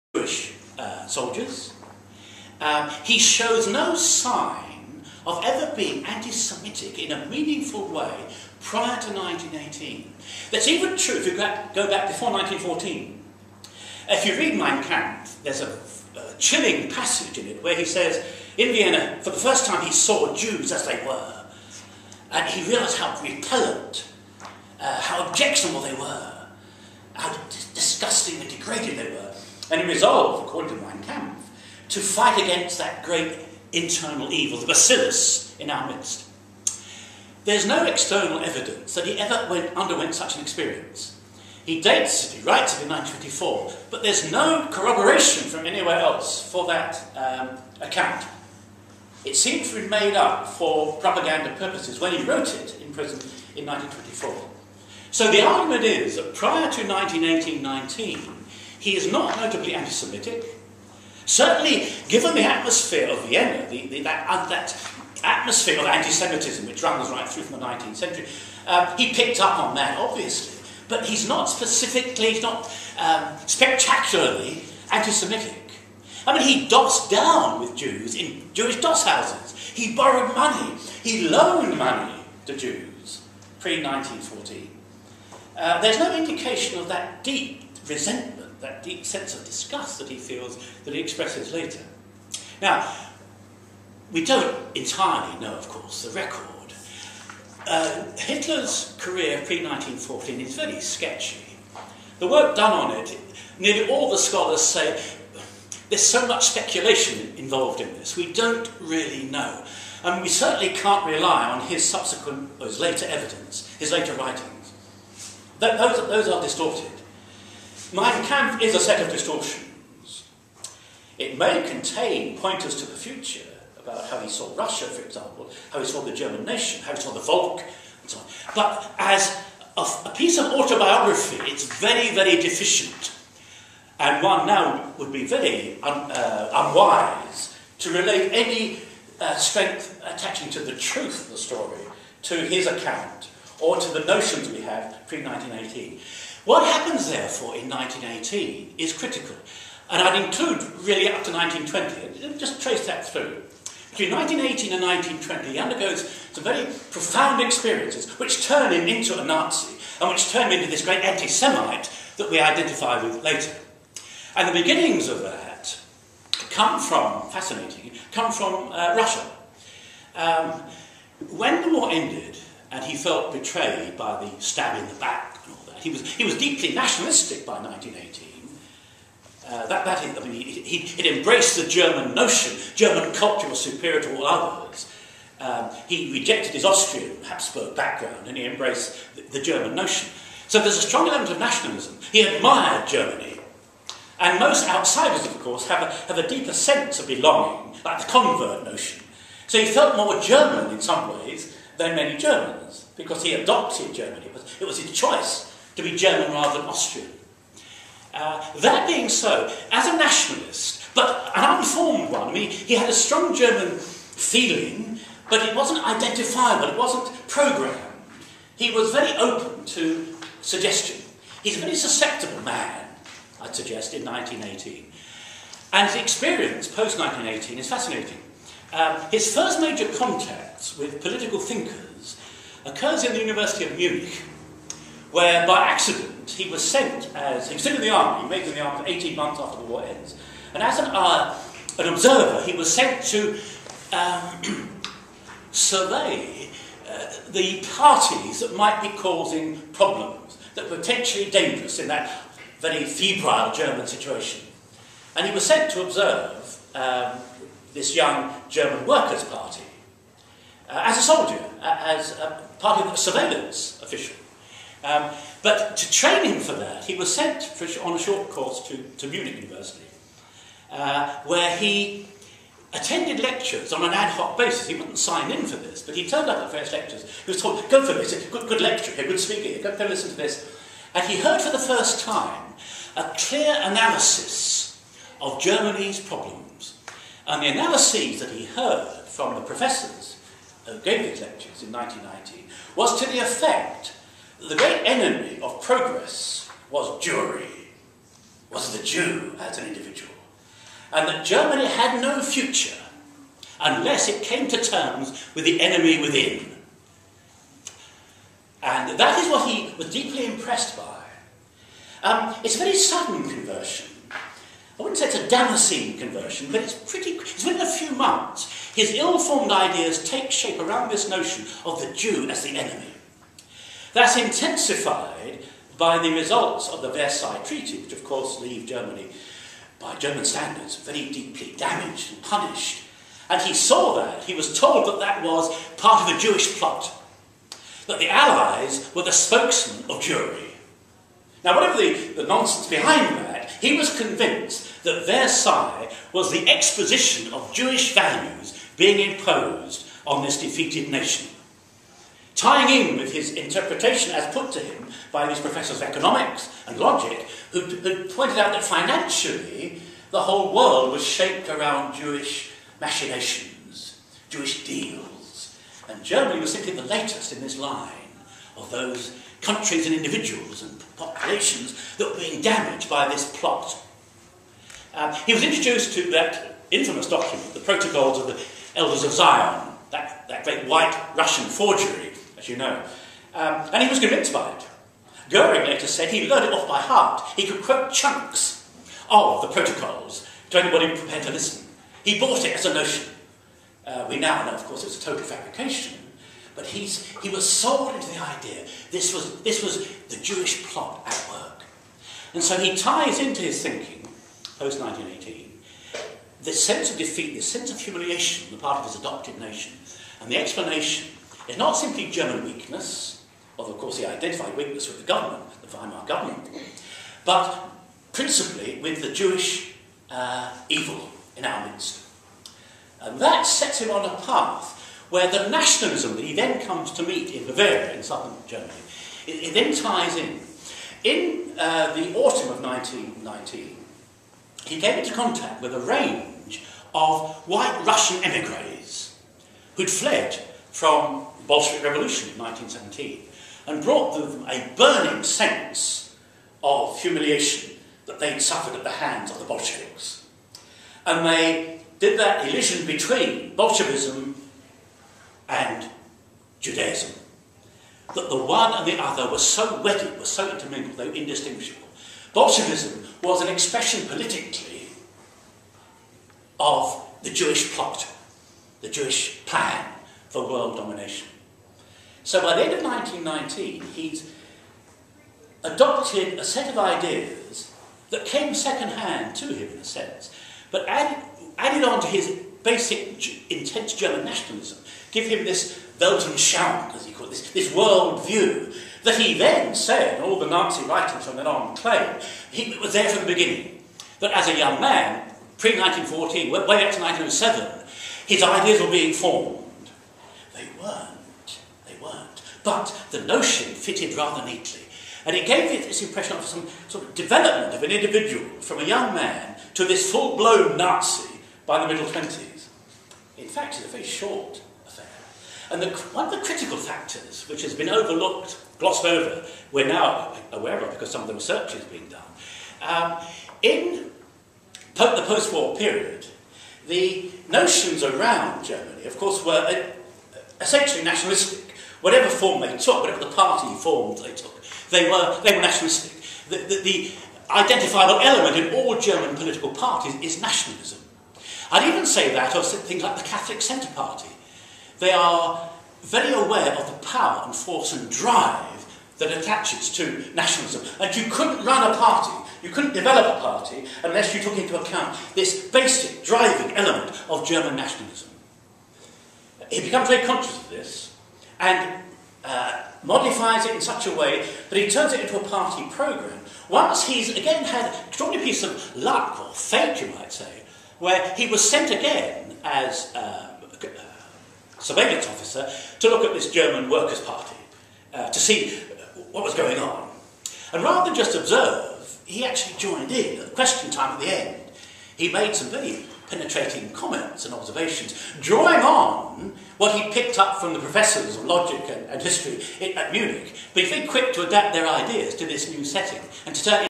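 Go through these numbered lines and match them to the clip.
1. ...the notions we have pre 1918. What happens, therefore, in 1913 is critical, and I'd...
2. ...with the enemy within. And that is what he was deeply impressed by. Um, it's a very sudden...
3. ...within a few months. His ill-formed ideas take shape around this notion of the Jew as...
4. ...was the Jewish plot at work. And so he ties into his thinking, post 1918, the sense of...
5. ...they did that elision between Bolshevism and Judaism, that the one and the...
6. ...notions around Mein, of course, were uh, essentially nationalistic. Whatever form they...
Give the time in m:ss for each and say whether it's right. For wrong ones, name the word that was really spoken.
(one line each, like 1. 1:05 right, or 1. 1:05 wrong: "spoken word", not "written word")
1. 2:23 wrong: "1918", not "1913"
2. 5:05 right
3. 5:17 right
4. 6:39 right
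5. 7:31 right
6. 8:47 wrong: "Germany", not "Mein".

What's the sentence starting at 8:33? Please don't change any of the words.
In fact, it's a very short affair.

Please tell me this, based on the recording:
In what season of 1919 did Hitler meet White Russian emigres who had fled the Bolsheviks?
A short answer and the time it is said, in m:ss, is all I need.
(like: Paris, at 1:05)
Autumn, at 7:11.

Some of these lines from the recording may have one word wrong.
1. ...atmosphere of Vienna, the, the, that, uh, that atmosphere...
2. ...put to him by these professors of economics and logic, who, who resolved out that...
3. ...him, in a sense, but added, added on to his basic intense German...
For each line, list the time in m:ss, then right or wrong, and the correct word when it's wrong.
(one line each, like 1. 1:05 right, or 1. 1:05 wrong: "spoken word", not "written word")
1. 1:02 right
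2. 5:54 wrong: "pointed", not "resolved"
3. 7:59 right.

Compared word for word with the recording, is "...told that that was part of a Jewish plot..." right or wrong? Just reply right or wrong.
right.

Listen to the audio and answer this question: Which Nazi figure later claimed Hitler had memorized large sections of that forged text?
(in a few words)
Goering.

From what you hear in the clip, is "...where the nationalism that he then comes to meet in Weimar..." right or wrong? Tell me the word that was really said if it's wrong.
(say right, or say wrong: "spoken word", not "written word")
wrong: "Bavaria", not "Weimar".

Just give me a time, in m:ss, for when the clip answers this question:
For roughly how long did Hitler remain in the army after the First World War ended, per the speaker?
3:58.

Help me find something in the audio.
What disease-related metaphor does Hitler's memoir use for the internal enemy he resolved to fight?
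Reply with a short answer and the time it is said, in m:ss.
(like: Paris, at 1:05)
the bacillus, at 0:34.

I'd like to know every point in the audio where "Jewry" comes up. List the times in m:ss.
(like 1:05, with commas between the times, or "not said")
4:57, 5:40.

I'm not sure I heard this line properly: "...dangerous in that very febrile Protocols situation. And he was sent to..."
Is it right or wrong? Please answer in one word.
wrong.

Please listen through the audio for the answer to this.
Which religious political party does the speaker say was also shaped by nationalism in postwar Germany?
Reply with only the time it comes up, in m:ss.
9:03.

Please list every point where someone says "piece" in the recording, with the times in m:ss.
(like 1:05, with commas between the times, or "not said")
2:10, 9:28.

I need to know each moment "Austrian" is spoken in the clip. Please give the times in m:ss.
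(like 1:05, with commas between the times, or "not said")
3:06, 3:26.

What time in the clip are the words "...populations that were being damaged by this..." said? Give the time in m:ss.
6:10.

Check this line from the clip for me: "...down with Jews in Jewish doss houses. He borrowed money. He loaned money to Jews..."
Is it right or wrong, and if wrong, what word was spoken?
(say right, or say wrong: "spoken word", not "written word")
right.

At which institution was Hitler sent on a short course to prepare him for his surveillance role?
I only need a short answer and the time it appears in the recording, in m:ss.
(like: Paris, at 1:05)
Munich University, at 4:29.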